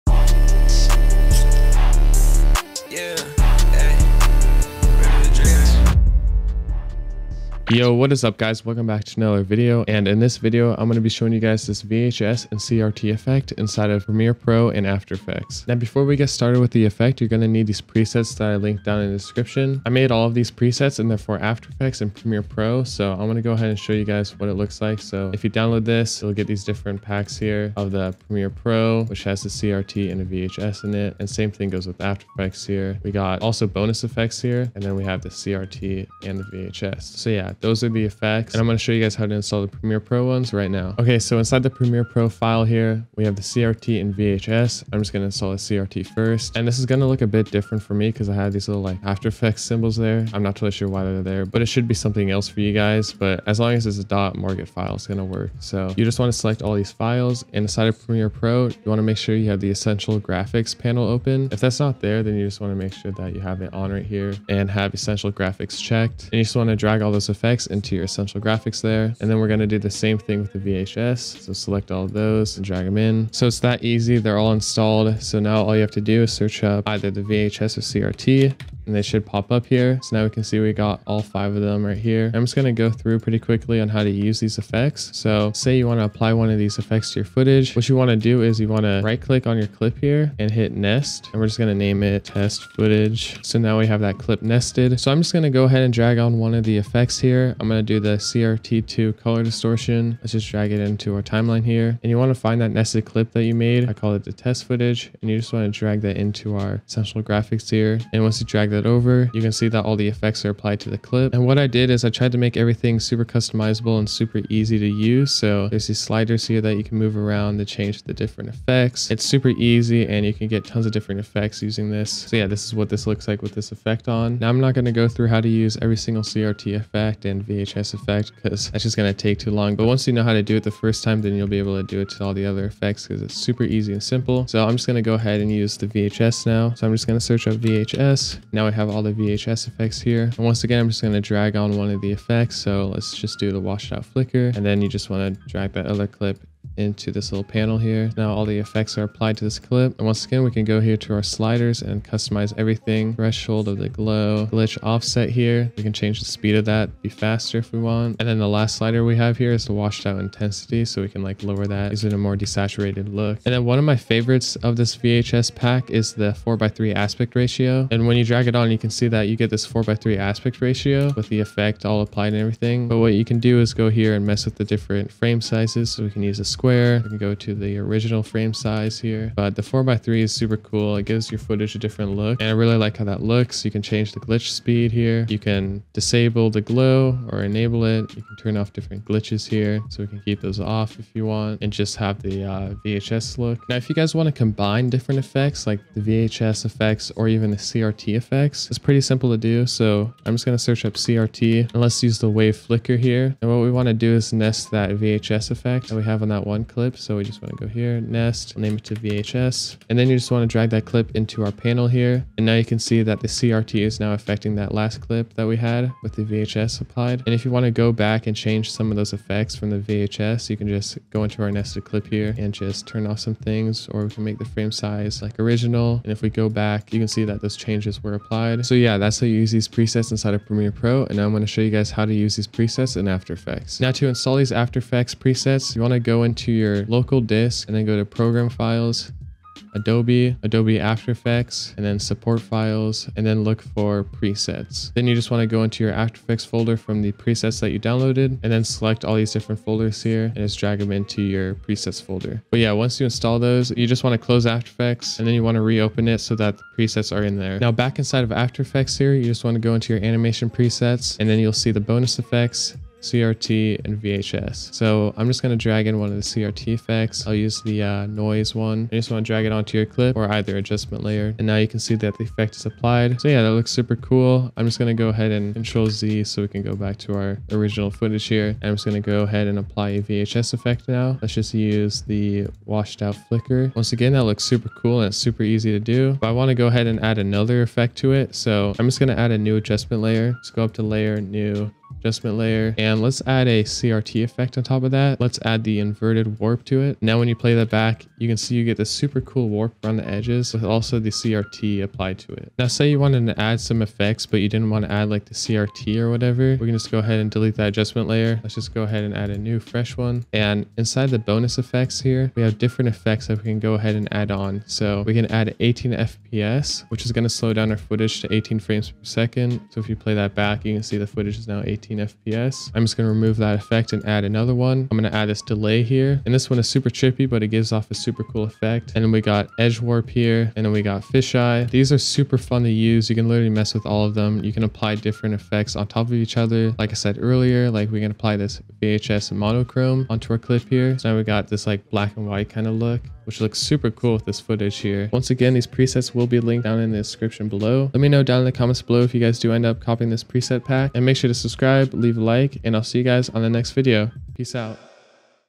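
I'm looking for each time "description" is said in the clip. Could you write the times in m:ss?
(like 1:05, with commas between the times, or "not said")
0:19, 5:46.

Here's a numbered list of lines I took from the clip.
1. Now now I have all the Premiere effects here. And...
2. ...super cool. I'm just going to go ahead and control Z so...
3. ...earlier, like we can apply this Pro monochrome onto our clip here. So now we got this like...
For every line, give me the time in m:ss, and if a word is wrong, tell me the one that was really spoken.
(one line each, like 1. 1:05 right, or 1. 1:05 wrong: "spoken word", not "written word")
1. 2:18 wrong: "VHS", not "Premiere"
2. 4:33 right
3. 5:37 wrong: "VHS", not "Pro".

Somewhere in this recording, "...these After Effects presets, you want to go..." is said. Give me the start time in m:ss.
3:54.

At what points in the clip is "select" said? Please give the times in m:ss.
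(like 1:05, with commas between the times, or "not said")
0:56, 1:11, 4:08.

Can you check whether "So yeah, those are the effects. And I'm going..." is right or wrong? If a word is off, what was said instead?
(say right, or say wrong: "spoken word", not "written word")
right.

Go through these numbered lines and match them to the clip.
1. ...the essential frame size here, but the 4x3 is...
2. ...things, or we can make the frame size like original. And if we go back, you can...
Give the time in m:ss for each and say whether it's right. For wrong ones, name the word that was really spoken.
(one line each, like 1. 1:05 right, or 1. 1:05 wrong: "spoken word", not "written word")
1. 2:57 wrong: "original", not "essential"
2. 3:43 right.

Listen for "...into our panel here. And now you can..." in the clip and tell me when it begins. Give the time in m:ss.
3:31.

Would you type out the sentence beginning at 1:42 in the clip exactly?
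And you want to find that nested clip that you made.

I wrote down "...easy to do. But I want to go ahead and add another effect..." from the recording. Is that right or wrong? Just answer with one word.
right.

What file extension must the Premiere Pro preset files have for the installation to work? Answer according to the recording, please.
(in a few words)
.mogrt.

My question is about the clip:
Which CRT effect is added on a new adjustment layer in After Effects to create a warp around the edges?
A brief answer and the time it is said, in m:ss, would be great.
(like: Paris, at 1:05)
inverted warp, at 4:55.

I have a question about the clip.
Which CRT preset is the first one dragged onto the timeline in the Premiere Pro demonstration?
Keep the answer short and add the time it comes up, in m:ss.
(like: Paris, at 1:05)
CRT2 color distortion, at 1:38.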